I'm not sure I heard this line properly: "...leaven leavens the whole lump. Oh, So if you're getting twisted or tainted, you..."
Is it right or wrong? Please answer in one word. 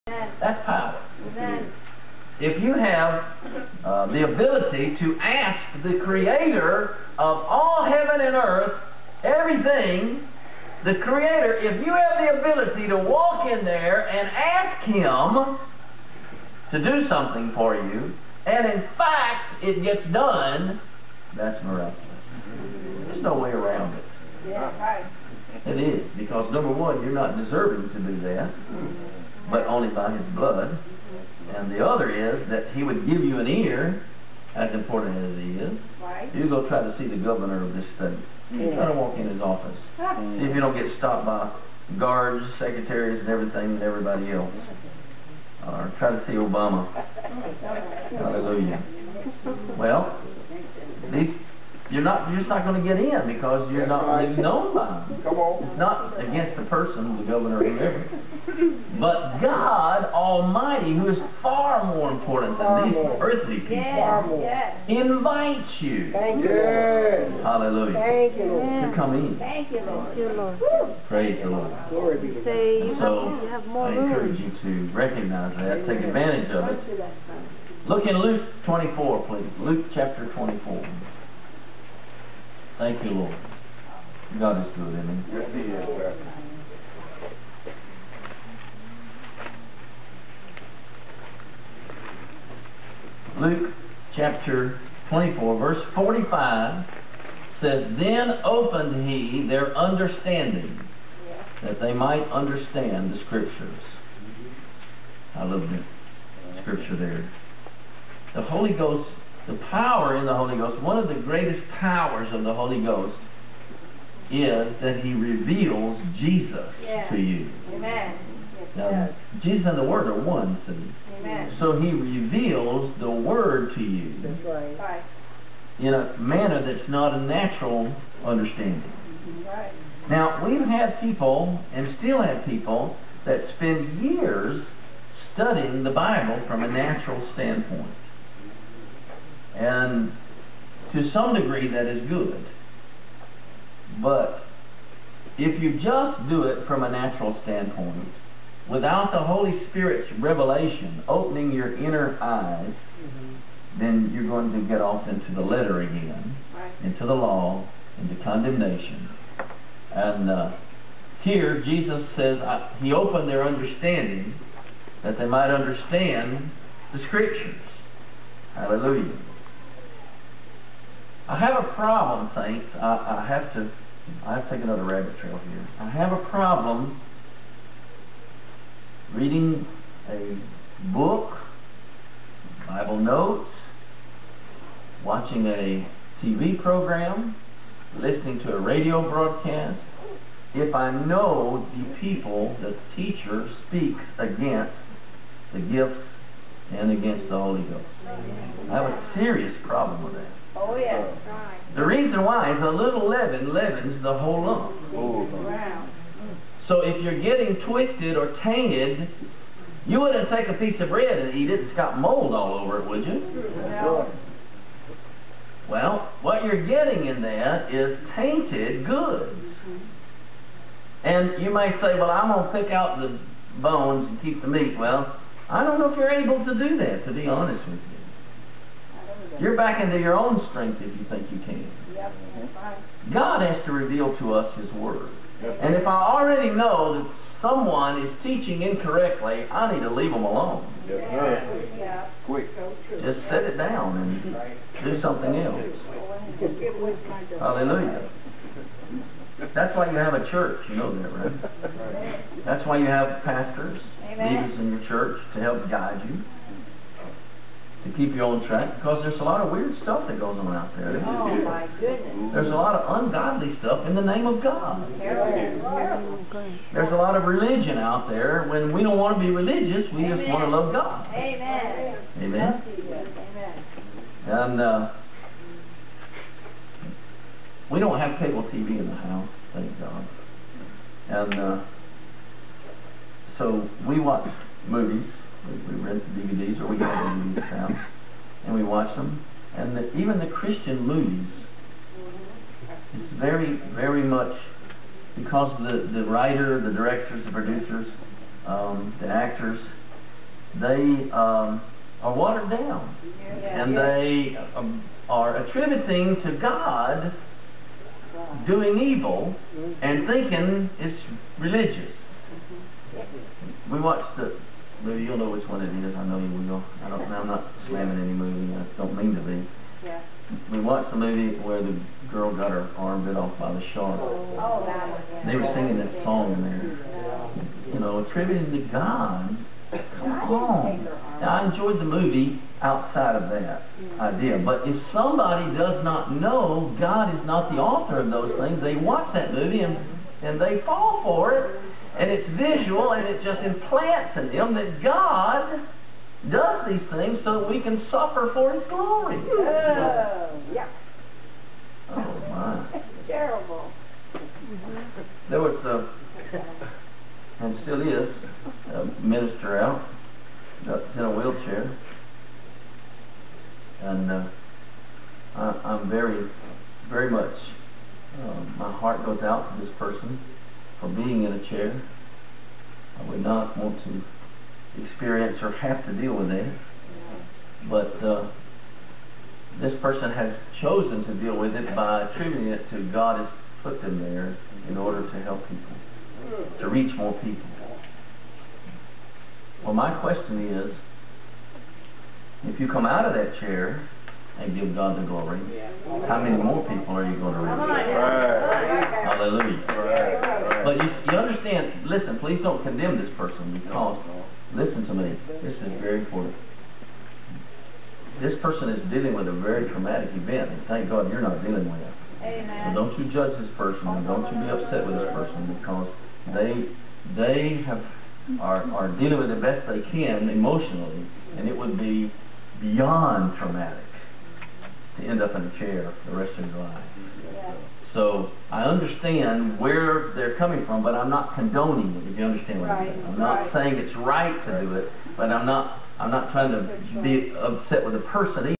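right.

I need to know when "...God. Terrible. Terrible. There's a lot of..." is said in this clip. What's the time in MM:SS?
04:24.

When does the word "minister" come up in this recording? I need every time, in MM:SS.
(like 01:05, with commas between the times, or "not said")
05:59.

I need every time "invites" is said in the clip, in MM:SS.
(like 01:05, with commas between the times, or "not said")
01:04.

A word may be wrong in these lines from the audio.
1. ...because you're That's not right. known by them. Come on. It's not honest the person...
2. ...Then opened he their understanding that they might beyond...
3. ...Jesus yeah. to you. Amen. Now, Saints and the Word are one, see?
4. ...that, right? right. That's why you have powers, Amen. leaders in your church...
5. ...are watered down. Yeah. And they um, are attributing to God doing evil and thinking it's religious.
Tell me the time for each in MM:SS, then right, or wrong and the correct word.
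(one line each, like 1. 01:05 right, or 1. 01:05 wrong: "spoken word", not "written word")
1. 00:53 wrong: "against", not "honest"
2. 01:37 wrong: "understand", not "beyond"
3. 01:56 wrong: "Jesus", not "Saints"
4. 04:11 wrong: "pastors", not "powers"
5. 05:02 right.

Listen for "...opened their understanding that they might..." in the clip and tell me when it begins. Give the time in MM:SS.
02:42.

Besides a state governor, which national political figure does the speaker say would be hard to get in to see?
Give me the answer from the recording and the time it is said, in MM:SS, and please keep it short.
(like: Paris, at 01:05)
Obama, at 00:46.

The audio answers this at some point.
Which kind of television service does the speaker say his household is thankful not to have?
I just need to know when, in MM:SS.
04:38.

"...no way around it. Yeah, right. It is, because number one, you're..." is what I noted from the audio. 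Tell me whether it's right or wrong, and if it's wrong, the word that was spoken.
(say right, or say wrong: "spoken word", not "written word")
right.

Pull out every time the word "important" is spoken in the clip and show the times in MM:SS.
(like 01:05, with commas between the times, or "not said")
00:34, 01:02, 06:45.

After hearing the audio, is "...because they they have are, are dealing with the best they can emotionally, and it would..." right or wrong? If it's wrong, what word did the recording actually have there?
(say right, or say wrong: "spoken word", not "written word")
right.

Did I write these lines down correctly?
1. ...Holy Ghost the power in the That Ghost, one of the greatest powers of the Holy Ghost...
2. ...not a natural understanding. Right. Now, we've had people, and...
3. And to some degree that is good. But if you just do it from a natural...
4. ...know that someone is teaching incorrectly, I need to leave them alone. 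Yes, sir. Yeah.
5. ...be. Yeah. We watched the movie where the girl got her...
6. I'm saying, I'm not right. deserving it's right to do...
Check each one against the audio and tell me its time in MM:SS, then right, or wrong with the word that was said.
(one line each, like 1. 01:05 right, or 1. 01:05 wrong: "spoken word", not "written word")
1. 01:48 wrong: "Holy", not "That"
2. 02:06 right
3. 02:19 right
4. 03:56 right
5. 05:19 right
6. 07:12 wrong: "saying", not "deserving".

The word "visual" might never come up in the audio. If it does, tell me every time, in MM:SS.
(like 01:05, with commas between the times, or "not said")
05:42.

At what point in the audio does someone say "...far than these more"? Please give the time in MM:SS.
01:02.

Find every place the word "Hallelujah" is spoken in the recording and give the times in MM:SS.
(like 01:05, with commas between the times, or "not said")
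00:48, 01:07, 02:48, 04:07, 06:39.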